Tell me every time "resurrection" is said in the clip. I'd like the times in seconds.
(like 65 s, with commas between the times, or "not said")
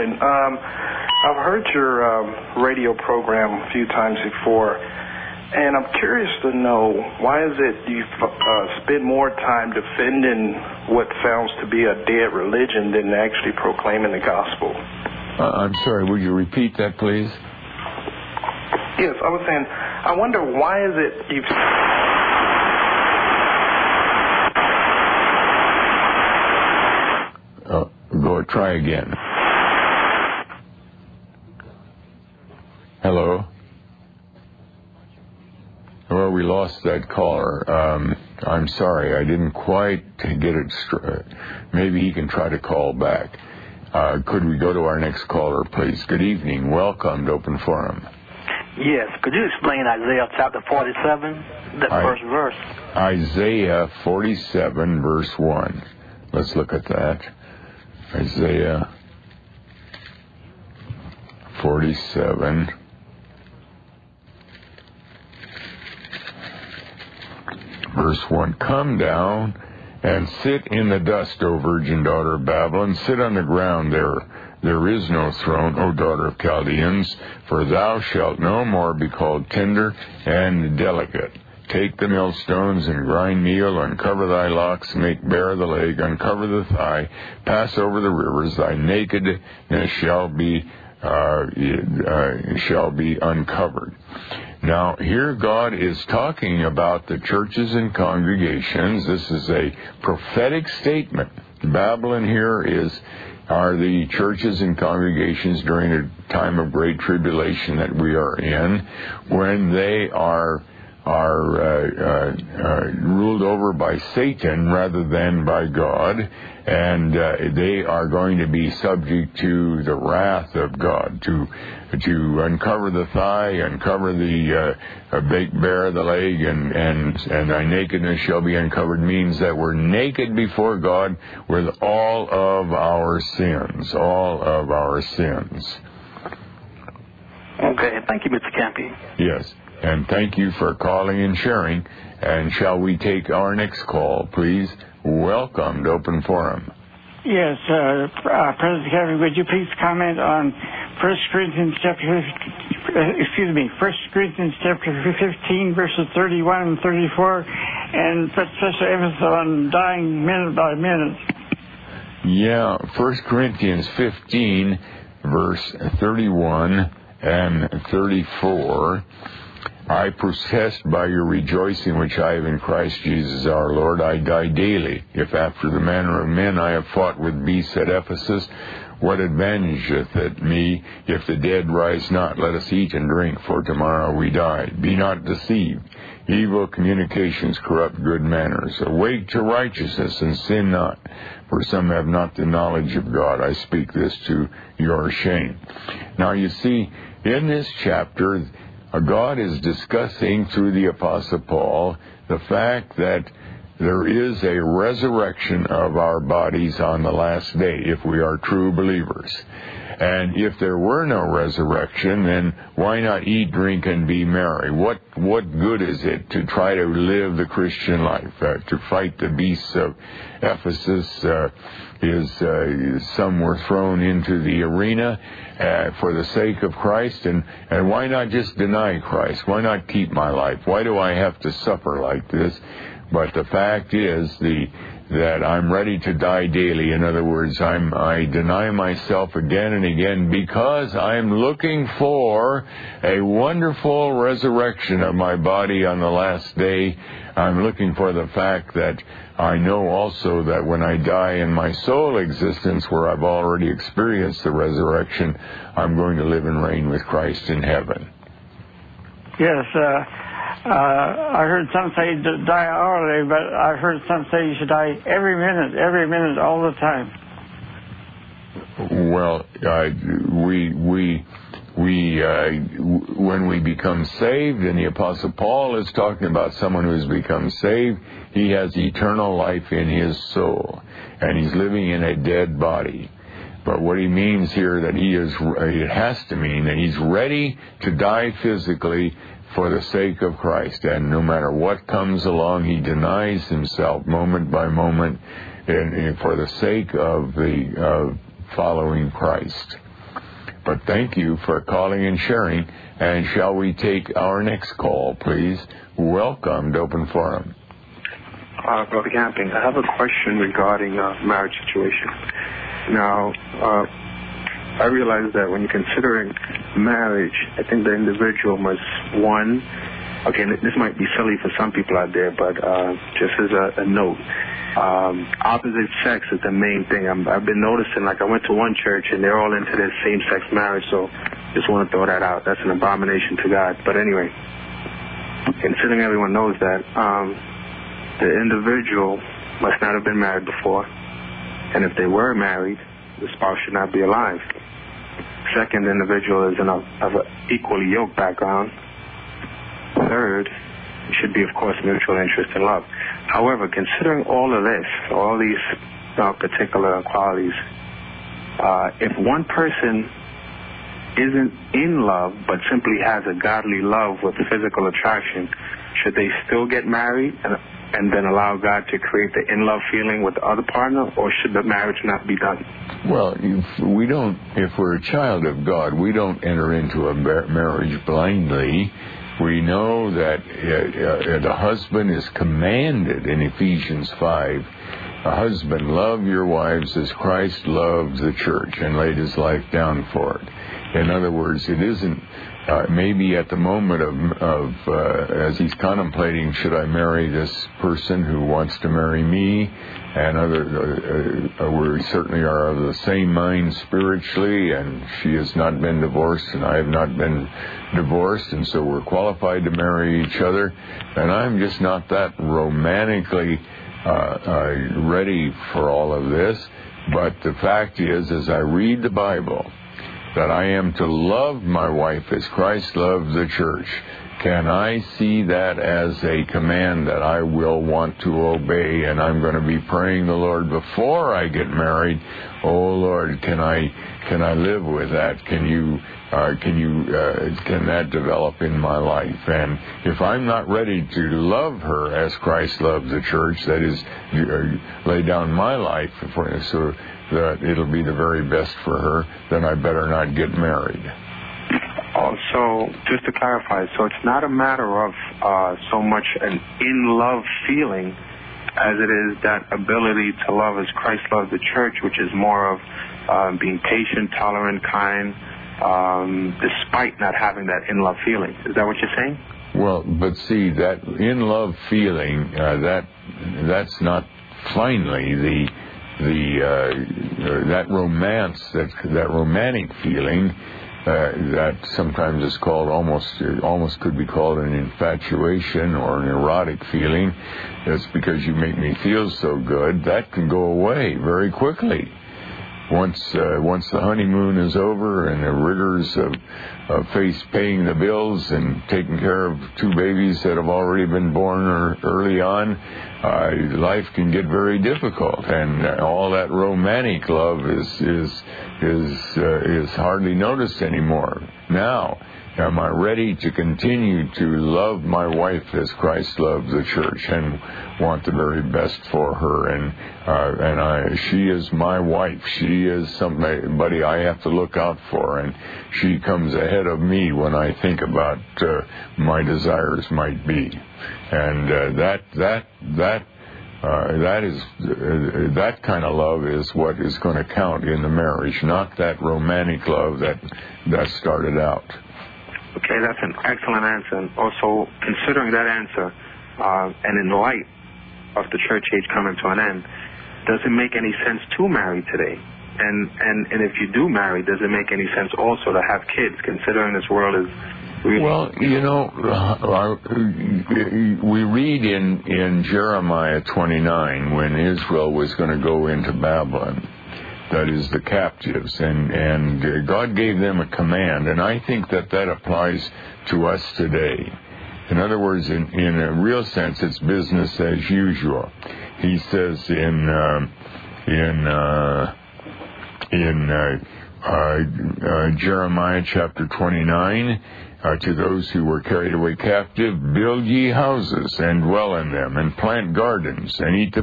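204 s, 211 s, 244 s, 254 s.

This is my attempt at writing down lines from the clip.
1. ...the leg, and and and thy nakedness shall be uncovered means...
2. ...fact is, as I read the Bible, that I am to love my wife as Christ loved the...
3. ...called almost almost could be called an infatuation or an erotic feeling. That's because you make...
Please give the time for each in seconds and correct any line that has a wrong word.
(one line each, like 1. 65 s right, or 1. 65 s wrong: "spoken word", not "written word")
1. 125 s right
2. 417 s right
3. 482 s right.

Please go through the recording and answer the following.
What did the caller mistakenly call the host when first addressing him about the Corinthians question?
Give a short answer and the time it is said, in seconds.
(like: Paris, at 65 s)
President Kennedy, at 148 s.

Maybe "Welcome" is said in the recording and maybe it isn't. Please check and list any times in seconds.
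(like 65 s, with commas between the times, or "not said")
46 s, 145 s, 305 s.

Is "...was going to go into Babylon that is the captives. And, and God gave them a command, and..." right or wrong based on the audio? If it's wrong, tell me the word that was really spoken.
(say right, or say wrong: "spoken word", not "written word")
right.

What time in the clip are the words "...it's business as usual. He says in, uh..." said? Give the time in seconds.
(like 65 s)
576 s.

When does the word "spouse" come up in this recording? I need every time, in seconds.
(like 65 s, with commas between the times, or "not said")
343 s.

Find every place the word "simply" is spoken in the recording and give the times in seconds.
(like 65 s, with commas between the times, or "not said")
362 s.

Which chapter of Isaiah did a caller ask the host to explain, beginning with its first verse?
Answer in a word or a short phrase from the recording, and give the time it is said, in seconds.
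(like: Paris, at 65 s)
47, at 49 s.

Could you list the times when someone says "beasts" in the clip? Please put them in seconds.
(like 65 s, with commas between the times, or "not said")
177 s, 219 s.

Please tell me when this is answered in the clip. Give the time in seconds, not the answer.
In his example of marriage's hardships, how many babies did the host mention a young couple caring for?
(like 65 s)
499 s.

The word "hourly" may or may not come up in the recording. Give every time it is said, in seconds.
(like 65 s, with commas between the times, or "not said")
262 s.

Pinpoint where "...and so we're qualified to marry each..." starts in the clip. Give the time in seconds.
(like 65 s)
408 s.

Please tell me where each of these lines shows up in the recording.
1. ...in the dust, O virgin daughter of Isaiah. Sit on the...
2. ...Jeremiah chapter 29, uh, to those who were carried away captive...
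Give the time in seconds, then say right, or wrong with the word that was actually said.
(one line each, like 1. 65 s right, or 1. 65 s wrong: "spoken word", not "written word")
1. 70 s wrong: "Babylon", not "Isaiah"
2. 585 s right.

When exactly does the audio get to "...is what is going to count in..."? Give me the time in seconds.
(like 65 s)
536 s.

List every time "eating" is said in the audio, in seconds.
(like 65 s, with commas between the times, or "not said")
not said.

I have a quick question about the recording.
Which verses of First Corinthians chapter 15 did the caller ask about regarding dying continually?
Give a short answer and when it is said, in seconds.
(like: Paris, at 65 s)
31 and 34, at 155 s.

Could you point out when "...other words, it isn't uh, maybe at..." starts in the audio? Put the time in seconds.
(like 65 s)
391 s.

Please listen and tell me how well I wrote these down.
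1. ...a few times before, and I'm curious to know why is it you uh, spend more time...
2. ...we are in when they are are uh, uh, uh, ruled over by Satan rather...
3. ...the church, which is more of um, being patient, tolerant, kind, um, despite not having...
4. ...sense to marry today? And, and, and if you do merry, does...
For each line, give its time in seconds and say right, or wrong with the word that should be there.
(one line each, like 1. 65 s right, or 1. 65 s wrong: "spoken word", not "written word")
1. 3 s right
2. 107 s right
3. 461 s right
4. 551 s wrong: "marry", not "merry".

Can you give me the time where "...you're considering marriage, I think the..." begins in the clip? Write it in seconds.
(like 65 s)
315 s.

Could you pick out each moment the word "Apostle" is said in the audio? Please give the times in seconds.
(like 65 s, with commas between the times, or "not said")
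200 s, 274 s.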